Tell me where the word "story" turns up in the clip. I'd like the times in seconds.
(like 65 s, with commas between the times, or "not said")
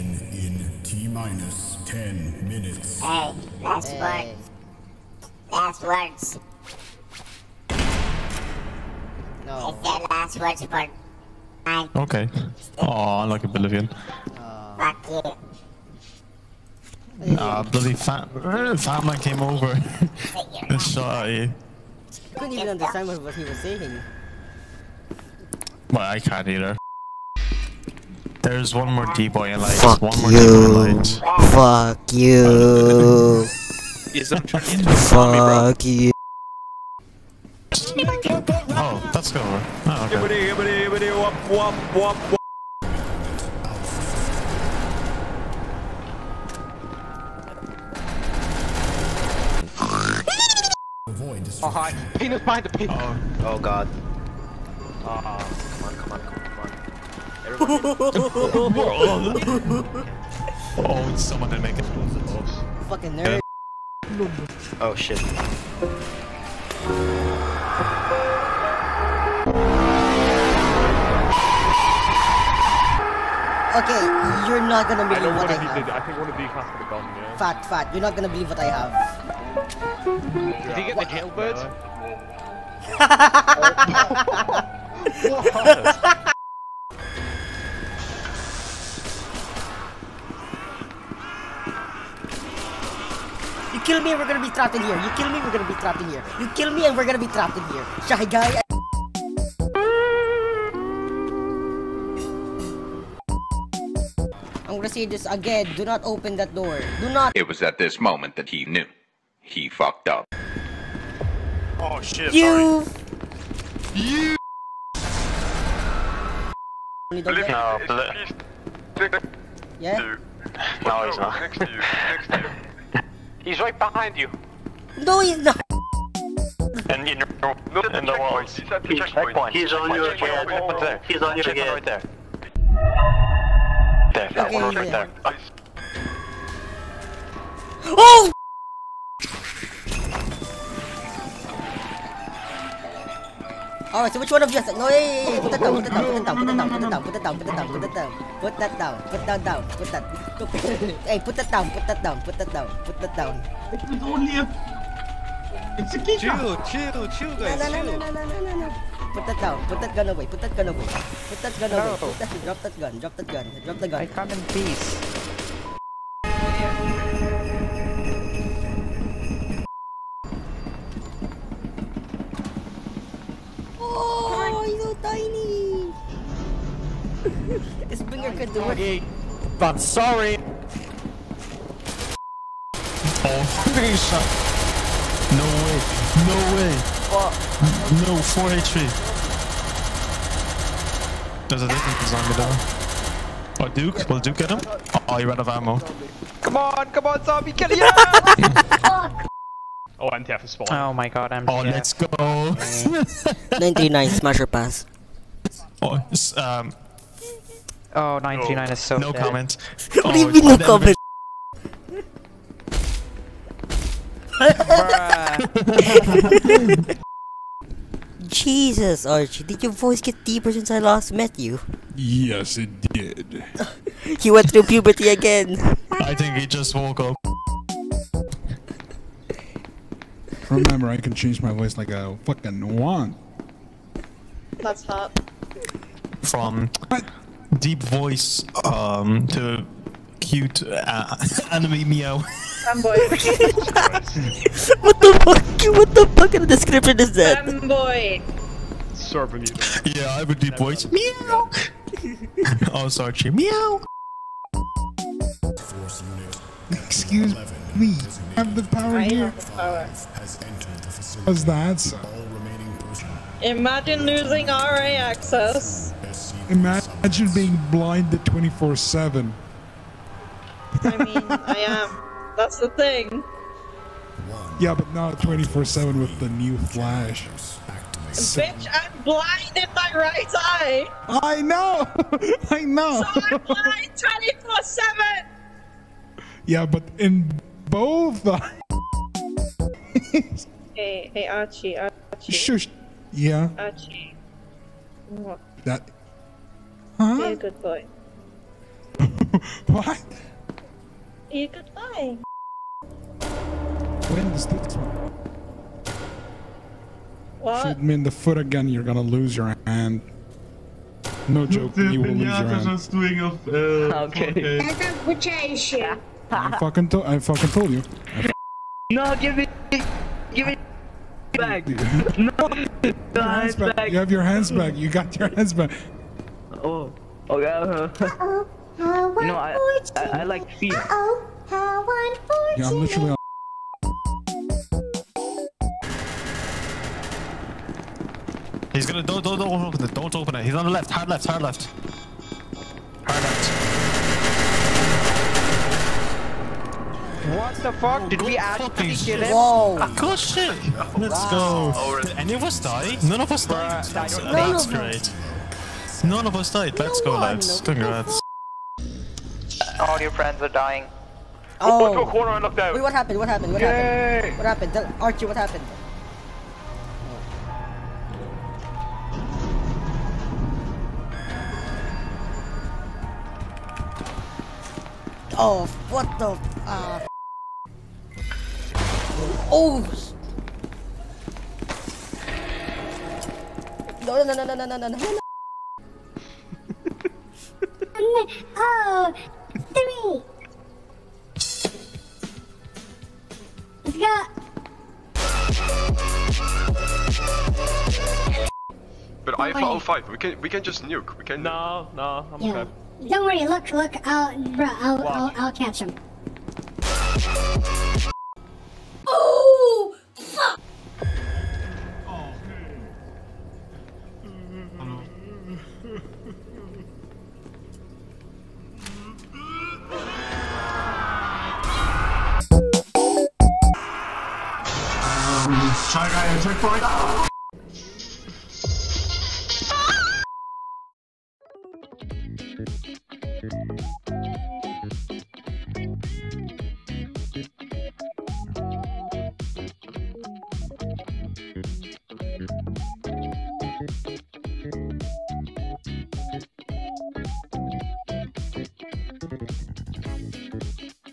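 not said.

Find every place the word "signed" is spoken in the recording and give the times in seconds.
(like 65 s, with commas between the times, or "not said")
not said.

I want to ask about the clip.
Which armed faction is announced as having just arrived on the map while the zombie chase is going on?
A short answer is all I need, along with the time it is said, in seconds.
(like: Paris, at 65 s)
MTF, at 200 s.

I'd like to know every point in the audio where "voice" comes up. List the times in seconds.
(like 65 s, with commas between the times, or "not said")
219 s, 231 s, 237 s, 250 s.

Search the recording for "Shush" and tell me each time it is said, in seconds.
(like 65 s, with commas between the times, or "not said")
292 s.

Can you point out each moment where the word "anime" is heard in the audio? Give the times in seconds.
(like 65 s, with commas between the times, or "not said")
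241 s.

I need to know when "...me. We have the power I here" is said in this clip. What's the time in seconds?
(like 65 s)
257 s.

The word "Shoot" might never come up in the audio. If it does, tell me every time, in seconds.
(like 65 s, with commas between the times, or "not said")
307 s.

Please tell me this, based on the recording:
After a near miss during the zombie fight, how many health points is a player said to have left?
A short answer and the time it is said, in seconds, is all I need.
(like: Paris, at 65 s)
4 HP, at 188 s.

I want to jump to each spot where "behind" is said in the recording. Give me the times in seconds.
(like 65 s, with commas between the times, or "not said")
52 s, 123 s.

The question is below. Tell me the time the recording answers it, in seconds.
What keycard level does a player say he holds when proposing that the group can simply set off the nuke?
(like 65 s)
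399 s.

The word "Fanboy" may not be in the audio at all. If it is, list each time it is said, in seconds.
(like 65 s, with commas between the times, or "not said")
242 s, 247 s.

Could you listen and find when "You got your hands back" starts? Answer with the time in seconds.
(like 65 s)
324 s.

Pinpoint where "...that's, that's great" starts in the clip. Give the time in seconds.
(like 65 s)
353 s.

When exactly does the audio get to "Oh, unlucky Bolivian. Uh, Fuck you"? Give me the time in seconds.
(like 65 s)
12 s.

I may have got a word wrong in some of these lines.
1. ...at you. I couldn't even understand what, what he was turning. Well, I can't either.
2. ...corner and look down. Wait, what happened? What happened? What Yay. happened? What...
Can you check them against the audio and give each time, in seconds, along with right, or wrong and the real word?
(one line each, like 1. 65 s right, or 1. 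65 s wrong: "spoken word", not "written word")
1. 21 s wrong: "saying", not "turning"
2. 362 s right.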